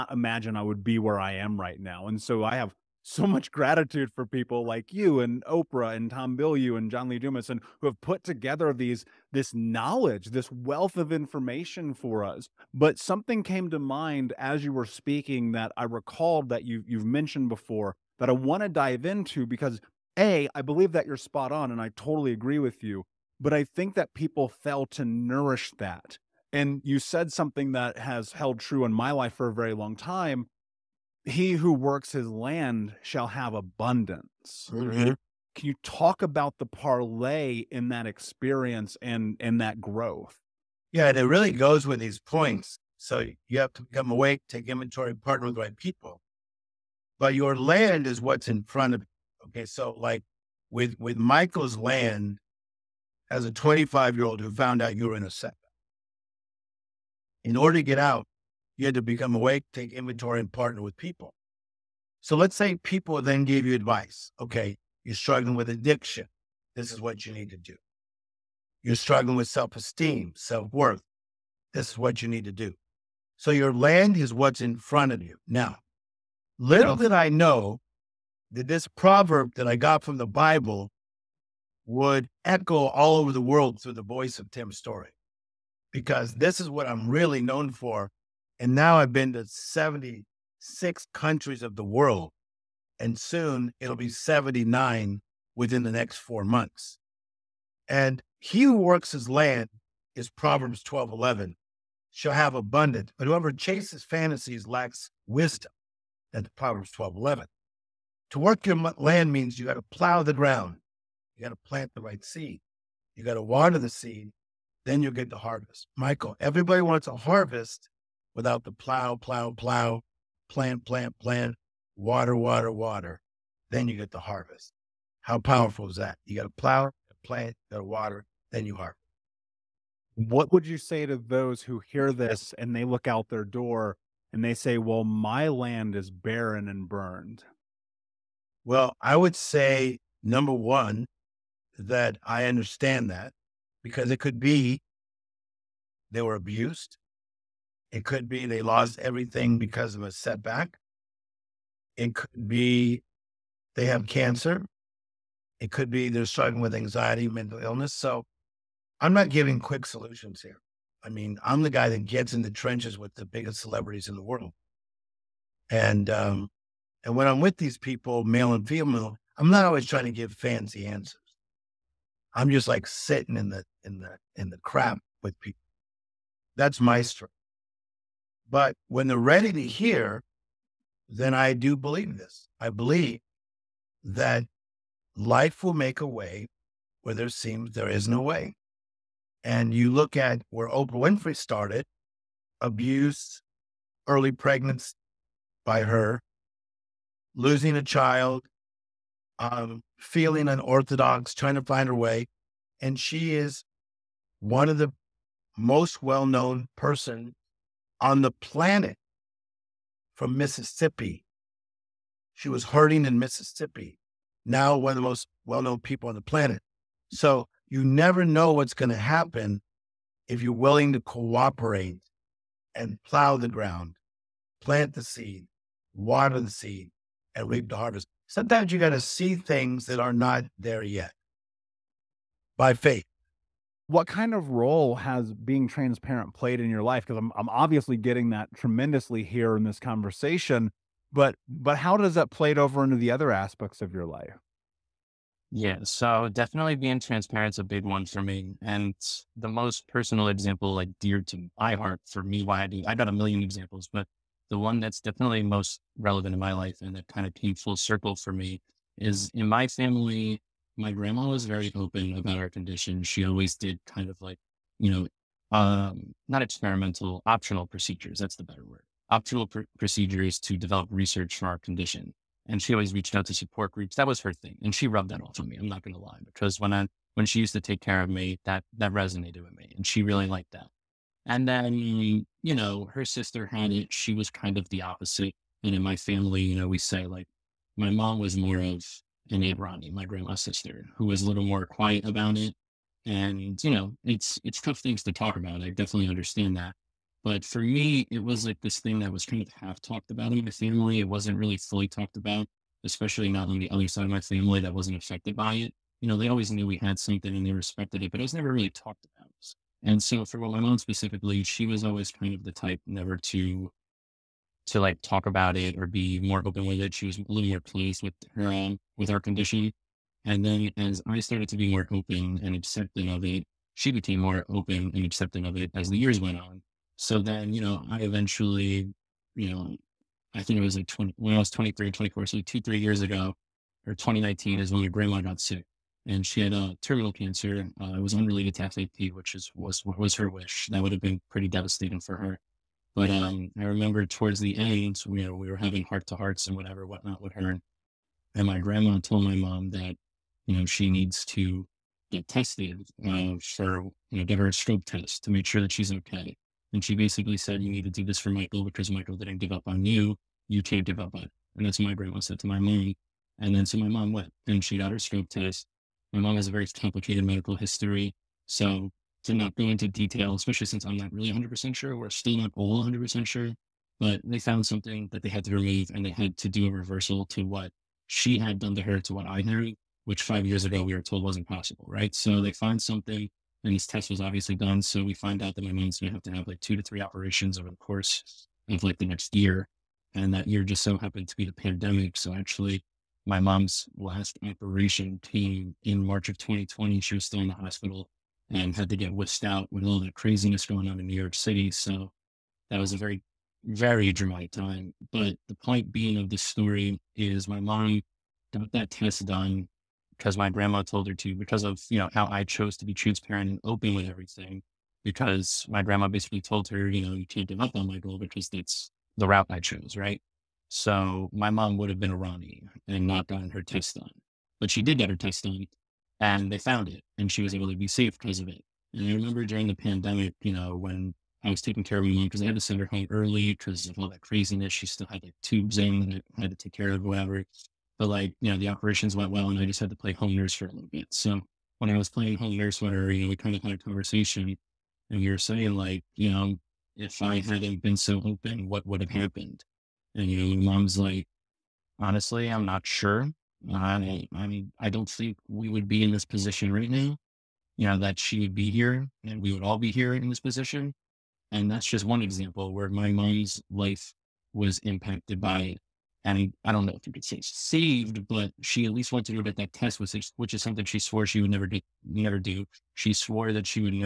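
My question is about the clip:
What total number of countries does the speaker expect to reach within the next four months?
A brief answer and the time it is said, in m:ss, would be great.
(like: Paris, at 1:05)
79, at 1:34.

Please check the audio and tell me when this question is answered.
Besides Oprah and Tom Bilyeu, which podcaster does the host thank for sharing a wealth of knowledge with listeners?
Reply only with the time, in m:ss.
0:06.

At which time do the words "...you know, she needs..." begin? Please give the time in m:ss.
5:50.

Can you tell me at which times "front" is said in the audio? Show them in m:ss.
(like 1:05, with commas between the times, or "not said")
0:48, 1:14.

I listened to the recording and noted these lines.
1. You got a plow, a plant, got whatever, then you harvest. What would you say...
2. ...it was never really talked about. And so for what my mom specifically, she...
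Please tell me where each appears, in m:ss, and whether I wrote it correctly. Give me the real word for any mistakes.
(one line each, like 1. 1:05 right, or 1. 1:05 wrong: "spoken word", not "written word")
1. 2:06 wrong: "water", not "whatever"
2. 5:08 right.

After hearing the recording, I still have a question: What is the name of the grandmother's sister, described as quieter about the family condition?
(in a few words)
Aunt Ronnie.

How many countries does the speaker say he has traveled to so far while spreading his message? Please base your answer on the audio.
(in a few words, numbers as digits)
76.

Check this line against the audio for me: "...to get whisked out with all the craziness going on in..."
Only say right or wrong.
right.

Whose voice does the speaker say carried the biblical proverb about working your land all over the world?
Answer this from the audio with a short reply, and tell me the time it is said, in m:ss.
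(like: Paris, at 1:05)
Tim Storey, at 1:24.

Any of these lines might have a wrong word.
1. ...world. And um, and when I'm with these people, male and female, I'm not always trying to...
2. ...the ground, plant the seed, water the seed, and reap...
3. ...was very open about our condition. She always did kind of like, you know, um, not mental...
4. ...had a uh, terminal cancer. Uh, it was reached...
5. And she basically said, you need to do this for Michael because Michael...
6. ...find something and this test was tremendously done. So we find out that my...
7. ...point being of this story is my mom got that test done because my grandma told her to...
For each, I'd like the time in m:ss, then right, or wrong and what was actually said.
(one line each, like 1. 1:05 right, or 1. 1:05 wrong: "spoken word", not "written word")
1. 2:44 right
2. 3:43 right
3. 4:21 wrong: "experimental", not "mental"
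4. 5:36 wrong: "unrelated", not "reached"
5. 5:56 right
6. 6:22 wrong: "obviously", not "tremendously"
7. 6:45 right.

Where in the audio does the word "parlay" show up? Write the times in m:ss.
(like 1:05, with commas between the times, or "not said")
0:36.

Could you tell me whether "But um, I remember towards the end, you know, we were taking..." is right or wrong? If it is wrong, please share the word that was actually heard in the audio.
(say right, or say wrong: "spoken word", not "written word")
wrong: "having", not "taking".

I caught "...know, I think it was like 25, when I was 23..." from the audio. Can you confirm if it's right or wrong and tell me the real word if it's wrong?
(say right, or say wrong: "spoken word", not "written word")
wrong: "20", not "25".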